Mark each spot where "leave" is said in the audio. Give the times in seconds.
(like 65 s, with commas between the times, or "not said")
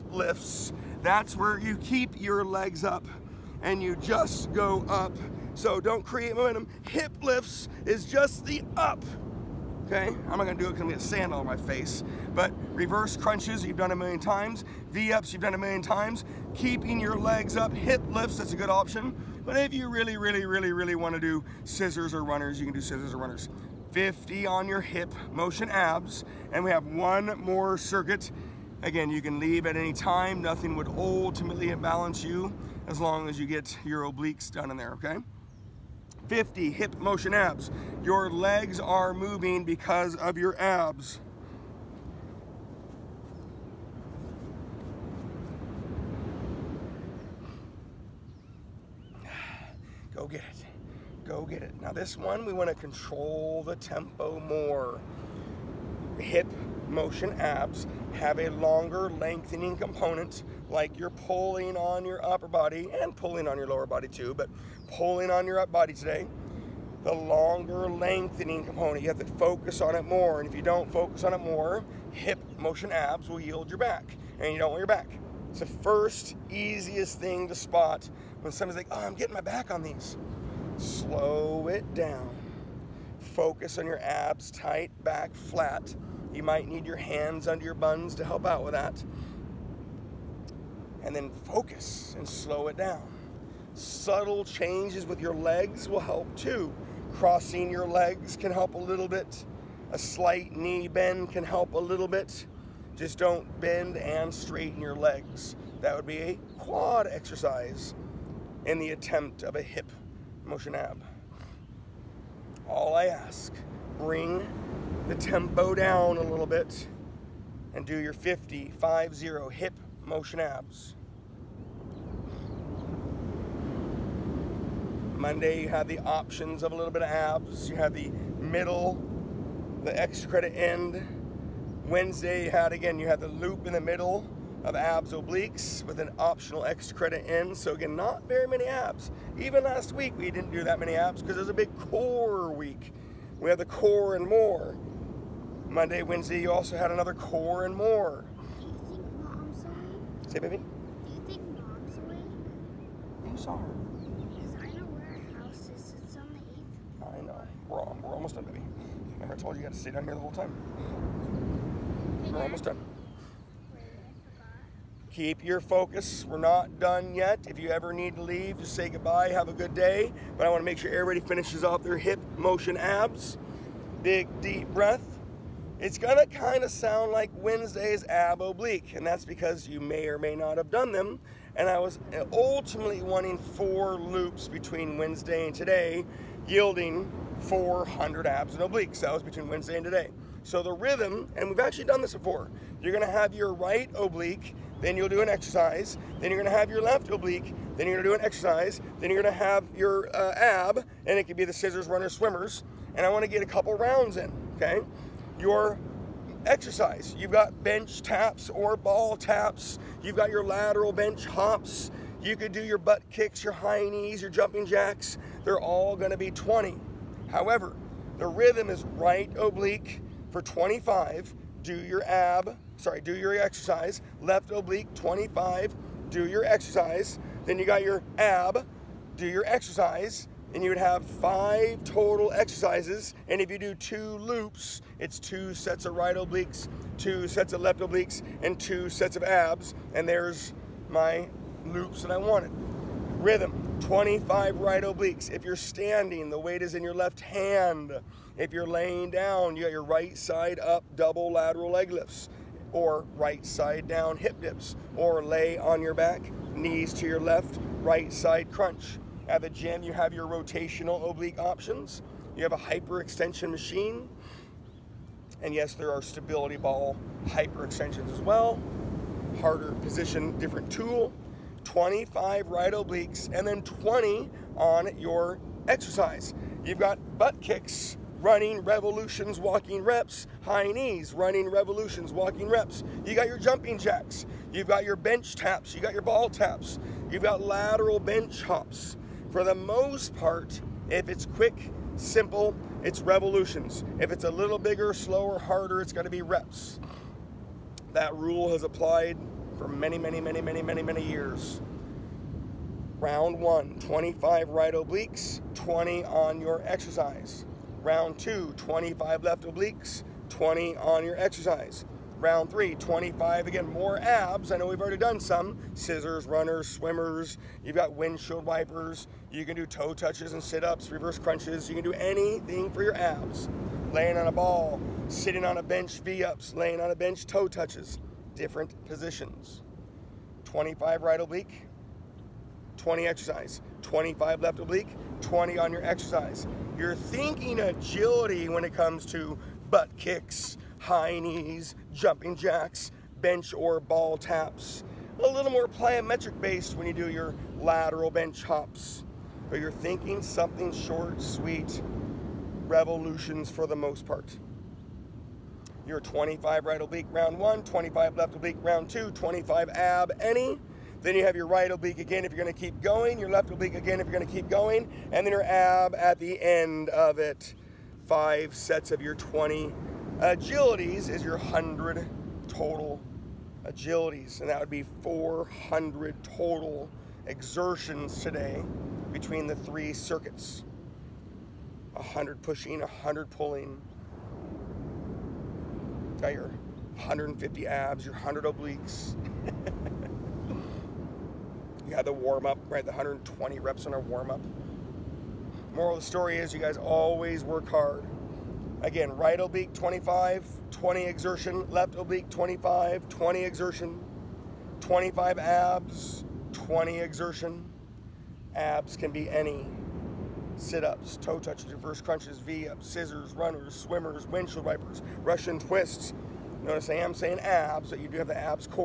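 29 s, 168 s.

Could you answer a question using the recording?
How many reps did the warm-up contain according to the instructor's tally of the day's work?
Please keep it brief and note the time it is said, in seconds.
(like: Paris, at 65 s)
120, at 392 s.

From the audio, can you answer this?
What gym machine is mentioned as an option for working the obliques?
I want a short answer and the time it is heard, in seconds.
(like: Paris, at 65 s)
hyperextension machine, at 262 s.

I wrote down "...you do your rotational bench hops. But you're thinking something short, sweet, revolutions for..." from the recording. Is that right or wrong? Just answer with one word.
wrong.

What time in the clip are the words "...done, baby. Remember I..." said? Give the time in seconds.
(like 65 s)
158 s.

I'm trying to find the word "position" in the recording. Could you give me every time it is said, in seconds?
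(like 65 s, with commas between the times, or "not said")
269 s, 328 s.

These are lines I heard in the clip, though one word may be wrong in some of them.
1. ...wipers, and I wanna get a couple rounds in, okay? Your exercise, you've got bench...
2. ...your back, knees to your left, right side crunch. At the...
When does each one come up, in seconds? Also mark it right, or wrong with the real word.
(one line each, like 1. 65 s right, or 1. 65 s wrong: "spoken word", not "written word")
1. 202 s wrong: "swimmers", not "wipers"
2. 255 s right.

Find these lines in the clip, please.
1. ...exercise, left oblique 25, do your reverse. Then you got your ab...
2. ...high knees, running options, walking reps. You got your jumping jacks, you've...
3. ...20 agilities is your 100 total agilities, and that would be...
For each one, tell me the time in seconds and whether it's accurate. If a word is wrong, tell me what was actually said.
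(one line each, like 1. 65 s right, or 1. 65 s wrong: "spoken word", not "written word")
1. 223 s wrong: "exercise", not "reverse"
2. 280 s wrong: "revolutions", not "options"
3. 369 s right.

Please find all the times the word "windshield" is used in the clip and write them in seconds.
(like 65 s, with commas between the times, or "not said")
317 s, 414 s.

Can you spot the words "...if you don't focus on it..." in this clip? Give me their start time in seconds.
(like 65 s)
70 s.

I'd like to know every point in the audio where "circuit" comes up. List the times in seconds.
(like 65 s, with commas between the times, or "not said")
27 s, 379 s.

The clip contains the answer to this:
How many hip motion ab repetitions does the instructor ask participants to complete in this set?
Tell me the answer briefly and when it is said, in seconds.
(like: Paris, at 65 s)
50, at 118 s.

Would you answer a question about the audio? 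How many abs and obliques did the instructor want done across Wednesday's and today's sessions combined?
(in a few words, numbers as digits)
400.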